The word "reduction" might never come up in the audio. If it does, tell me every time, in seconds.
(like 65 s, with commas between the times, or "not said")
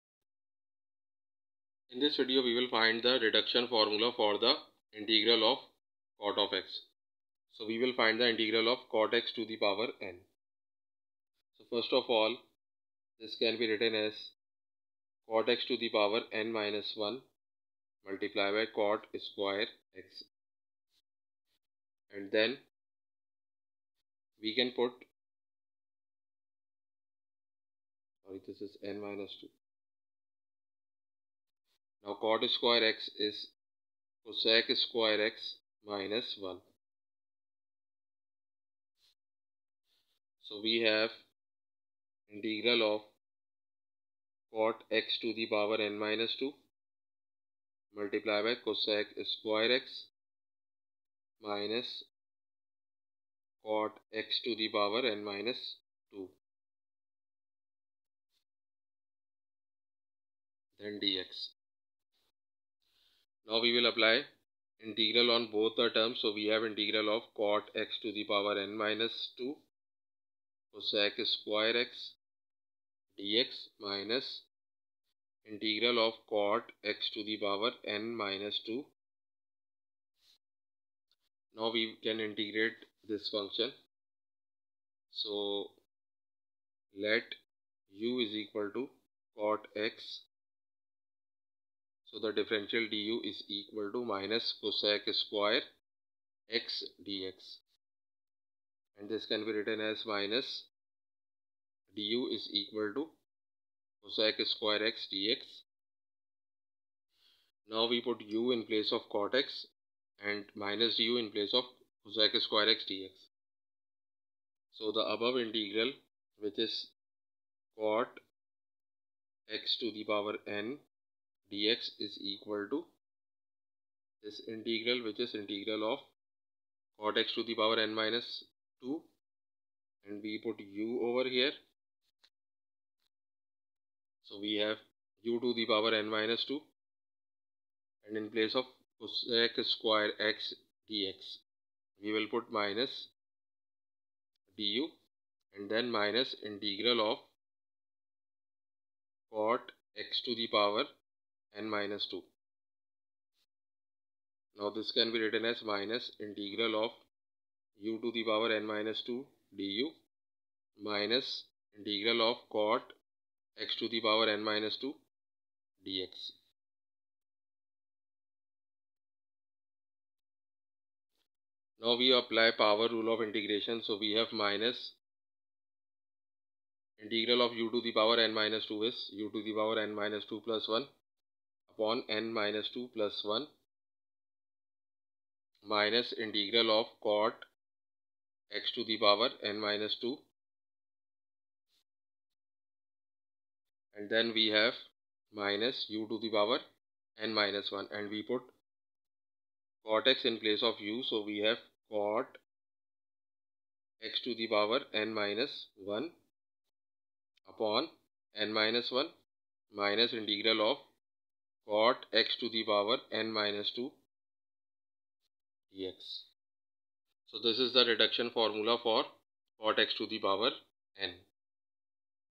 3 s, 217 s.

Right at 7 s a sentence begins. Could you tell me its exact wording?
So we will find the integral of cot x to the power n.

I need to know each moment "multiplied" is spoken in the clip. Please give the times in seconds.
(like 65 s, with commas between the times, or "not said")
18 s, 47 s.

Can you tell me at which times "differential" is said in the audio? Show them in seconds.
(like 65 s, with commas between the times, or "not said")
92 s.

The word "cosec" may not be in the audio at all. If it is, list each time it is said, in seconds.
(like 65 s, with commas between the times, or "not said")
34 s, 48 s, 70 s, 94 s, 104 s, 112 s, 139 s.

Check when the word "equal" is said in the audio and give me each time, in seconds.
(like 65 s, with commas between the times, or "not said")
88 s, 93 s, 102 s, 122 s.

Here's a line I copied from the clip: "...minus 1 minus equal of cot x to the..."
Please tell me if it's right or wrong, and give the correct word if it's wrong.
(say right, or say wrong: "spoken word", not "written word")
wrong: "integral", not "equal".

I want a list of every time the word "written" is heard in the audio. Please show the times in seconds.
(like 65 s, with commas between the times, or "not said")
13 s, 99 s, 155 s.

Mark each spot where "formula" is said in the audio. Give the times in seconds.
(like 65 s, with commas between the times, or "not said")
3 s, 218 s.